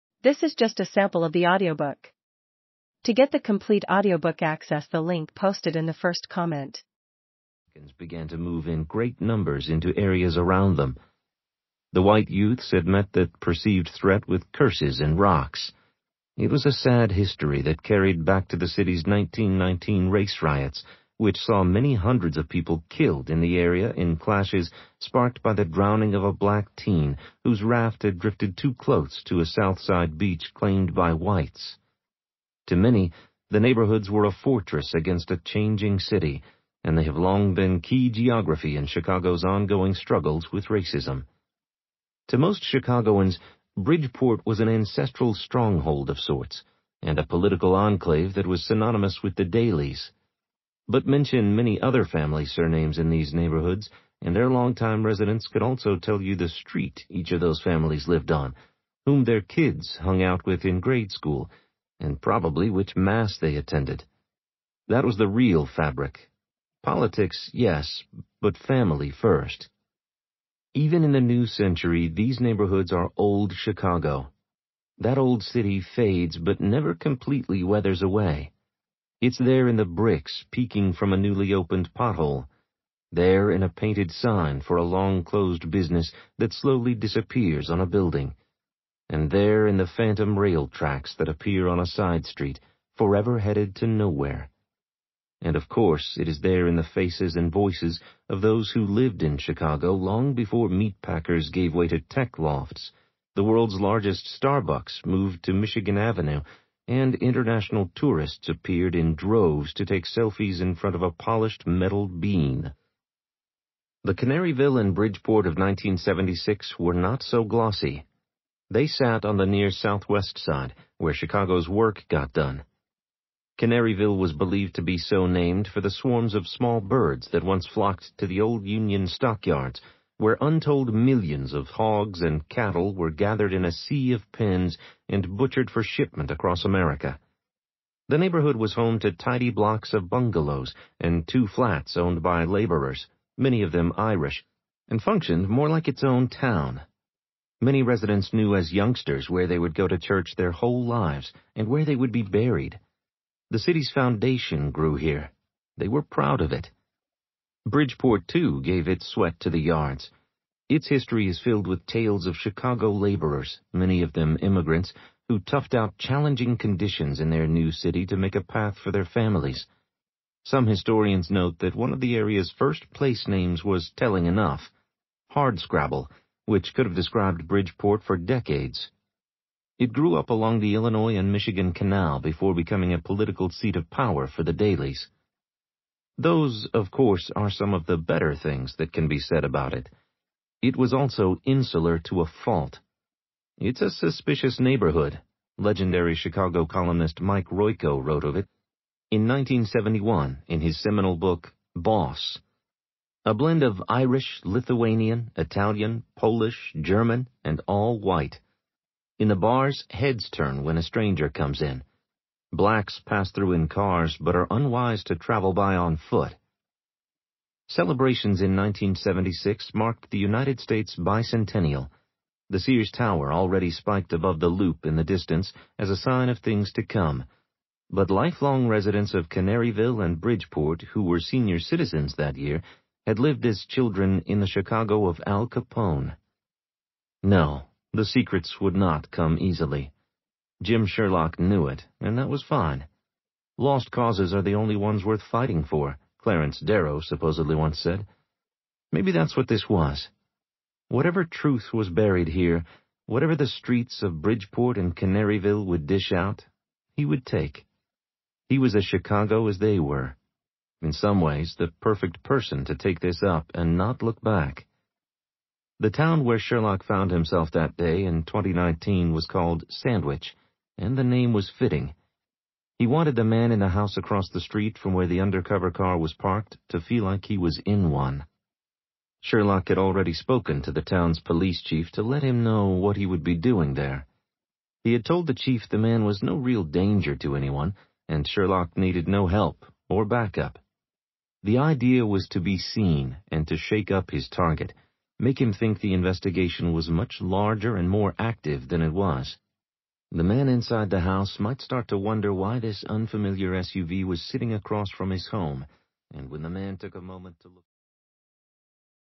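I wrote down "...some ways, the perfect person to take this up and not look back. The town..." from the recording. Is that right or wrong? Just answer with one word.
right.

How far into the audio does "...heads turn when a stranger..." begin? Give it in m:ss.
3:29.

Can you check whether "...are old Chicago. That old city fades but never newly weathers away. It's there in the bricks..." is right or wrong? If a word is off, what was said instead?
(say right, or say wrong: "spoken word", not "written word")
wrong: "completely", not "newly".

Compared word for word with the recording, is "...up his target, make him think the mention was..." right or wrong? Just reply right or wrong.
wrong.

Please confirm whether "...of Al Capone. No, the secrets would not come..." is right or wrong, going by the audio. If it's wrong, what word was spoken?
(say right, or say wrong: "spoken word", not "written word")
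right.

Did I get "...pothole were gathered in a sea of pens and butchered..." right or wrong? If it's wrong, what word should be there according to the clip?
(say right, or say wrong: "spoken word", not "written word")
wrong: "cattle", not "pothole".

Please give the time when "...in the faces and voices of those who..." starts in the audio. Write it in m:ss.
1:36.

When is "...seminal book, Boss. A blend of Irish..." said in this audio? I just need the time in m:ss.
3:20.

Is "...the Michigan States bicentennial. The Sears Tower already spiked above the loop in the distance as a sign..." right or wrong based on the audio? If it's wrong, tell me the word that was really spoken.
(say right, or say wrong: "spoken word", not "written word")
wrong: "United", not "Michigan".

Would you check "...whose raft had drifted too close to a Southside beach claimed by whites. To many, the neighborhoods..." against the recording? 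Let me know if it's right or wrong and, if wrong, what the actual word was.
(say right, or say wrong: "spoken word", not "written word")
right.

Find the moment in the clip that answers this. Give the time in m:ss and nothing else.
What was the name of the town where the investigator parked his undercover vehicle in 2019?
4:29.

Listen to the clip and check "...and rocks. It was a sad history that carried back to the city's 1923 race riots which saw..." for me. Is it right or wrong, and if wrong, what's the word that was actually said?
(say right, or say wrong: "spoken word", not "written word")
wrong: "1919", not "1923".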